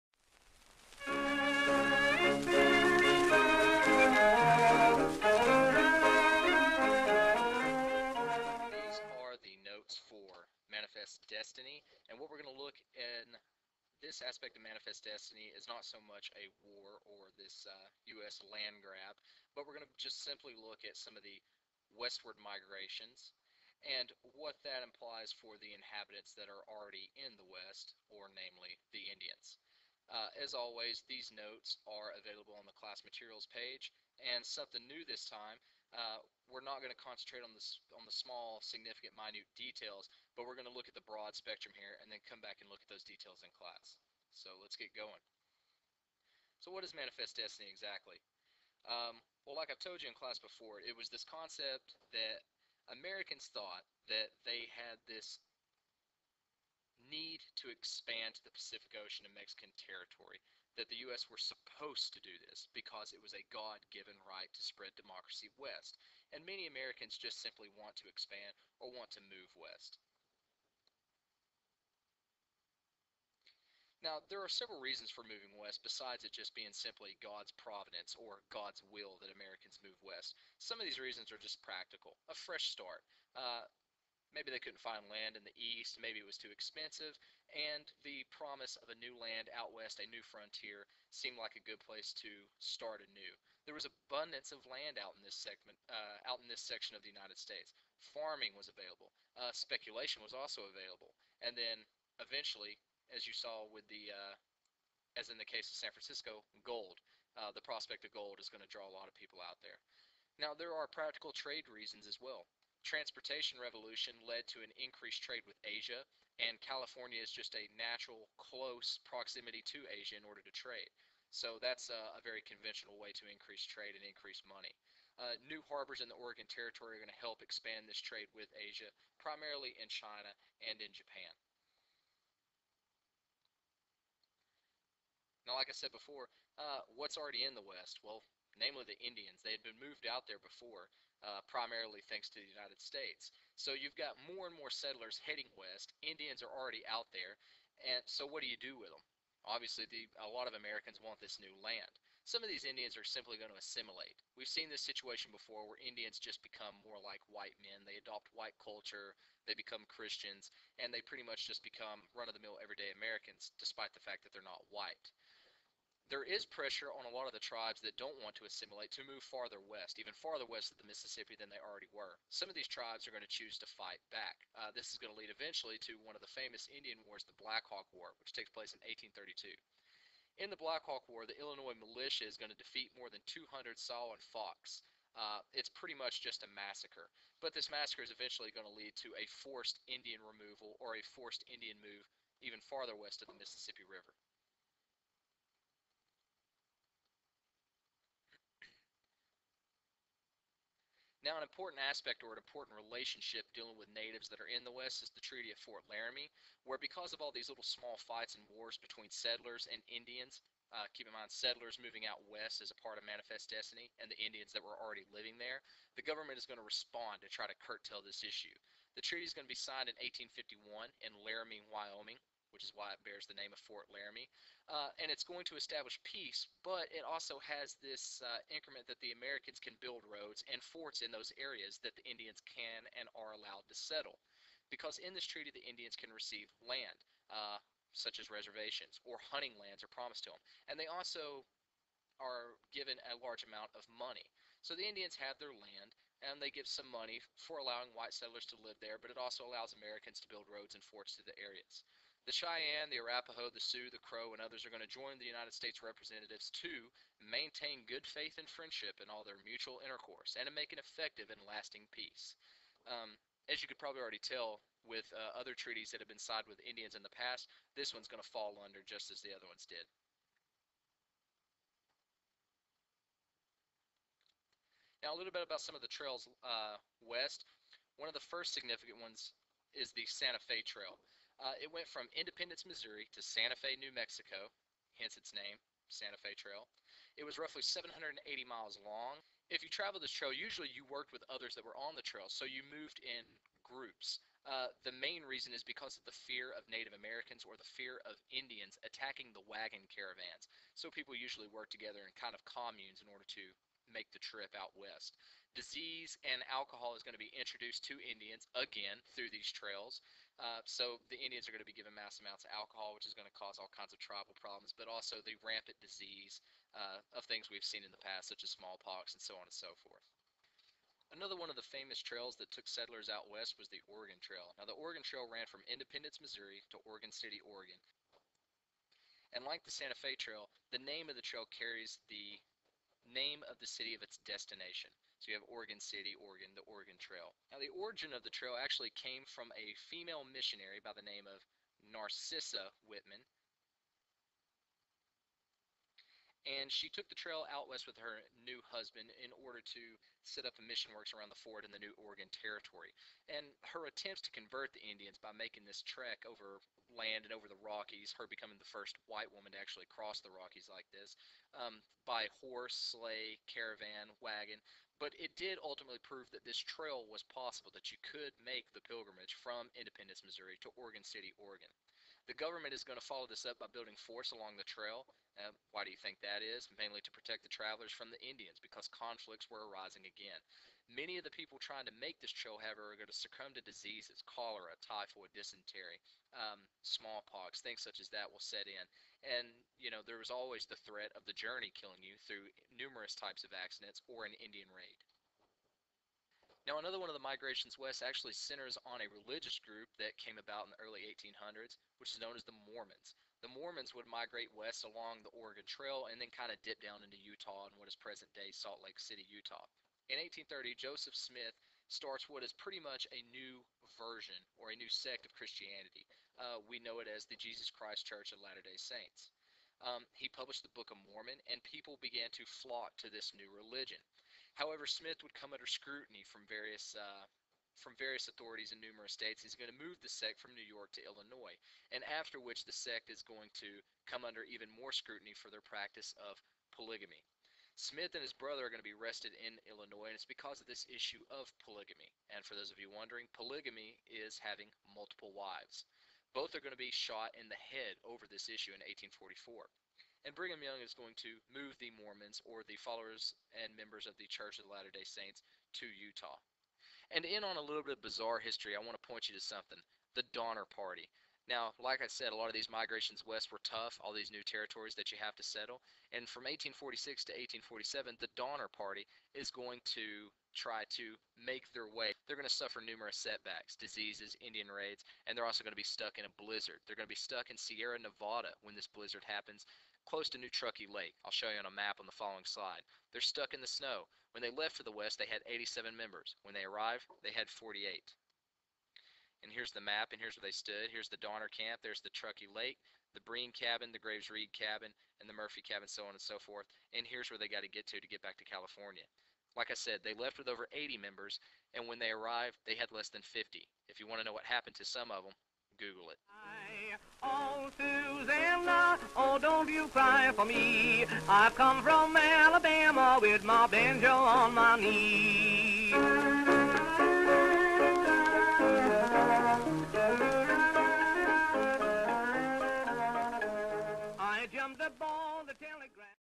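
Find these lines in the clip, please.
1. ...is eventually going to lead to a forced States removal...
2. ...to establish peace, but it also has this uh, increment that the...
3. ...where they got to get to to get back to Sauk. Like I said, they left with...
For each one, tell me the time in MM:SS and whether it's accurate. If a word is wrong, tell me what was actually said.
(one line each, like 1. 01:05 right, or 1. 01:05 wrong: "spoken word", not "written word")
1. 03:08 wrong: "Indian", not "States"
2. 03:45 right
3. 08:17 wrong: "California", not "Sauk".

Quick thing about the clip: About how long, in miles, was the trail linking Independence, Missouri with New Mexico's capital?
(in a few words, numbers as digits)
780.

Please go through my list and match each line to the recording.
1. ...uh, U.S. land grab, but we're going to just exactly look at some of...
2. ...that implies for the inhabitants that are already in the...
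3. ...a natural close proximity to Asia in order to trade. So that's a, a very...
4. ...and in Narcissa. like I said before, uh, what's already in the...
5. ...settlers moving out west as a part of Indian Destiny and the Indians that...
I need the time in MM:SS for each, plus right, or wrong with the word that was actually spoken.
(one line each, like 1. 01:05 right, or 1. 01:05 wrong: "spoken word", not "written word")
1. 00:17 wrong: "simply", not "exactly"
2. 00:24 right
3. 01:57 right
4. 02:10 wrong: "Japan", not "Narcissa"
5. 03:31 wrong: "Manifest", not "Indian".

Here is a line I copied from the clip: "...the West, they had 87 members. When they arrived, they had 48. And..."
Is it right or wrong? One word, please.
right.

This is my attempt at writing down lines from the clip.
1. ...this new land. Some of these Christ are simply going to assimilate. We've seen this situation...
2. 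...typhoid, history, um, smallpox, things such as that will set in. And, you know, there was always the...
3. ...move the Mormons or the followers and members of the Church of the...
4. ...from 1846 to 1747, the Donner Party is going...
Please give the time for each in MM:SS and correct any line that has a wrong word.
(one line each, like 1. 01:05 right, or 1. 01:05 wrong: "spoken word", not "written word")
1. 02:31 wrong: "Indians", not "Christ"
2. 06:24 wrong: "dysentery", not "history"
3. 07:31 right
4. 07:46 wrong: "1847", not "1747".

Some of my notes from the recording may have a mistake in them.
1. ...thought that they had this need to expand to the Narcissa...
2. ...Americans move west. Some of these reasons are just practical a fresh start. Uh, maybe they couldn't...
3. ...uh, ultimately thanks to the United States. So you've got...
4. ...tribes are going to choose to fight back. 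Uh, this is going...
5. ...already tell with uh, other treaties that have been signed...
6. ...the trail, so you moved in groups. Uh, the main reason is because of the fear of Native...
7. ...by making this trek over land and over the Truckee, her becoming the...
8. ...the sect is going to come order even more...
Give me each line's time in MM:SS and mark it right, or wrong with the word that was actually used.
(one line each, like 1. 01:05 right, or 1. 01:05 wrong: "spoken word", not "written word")
1. 00:53 wrong: "Pacific", not "Narcissa"
2. 01:19 right
3. 02:21 wrong: "primarily", not "ultimately"
4. 02:52 right
5. 04:24 right
6. 04:51 right
7. 05:55 wrong: "Rockies", not "Truckee"
8. 07:12 wrong: "under", not "order".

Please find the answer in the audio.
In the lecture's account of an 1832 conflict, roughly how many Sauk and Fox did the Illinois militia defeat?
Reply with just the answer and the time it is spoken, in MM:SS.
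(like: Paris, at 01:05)
more than 200, at 03:02.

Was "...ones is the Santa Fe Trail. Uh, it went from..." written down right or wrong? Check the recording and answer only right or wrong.
right.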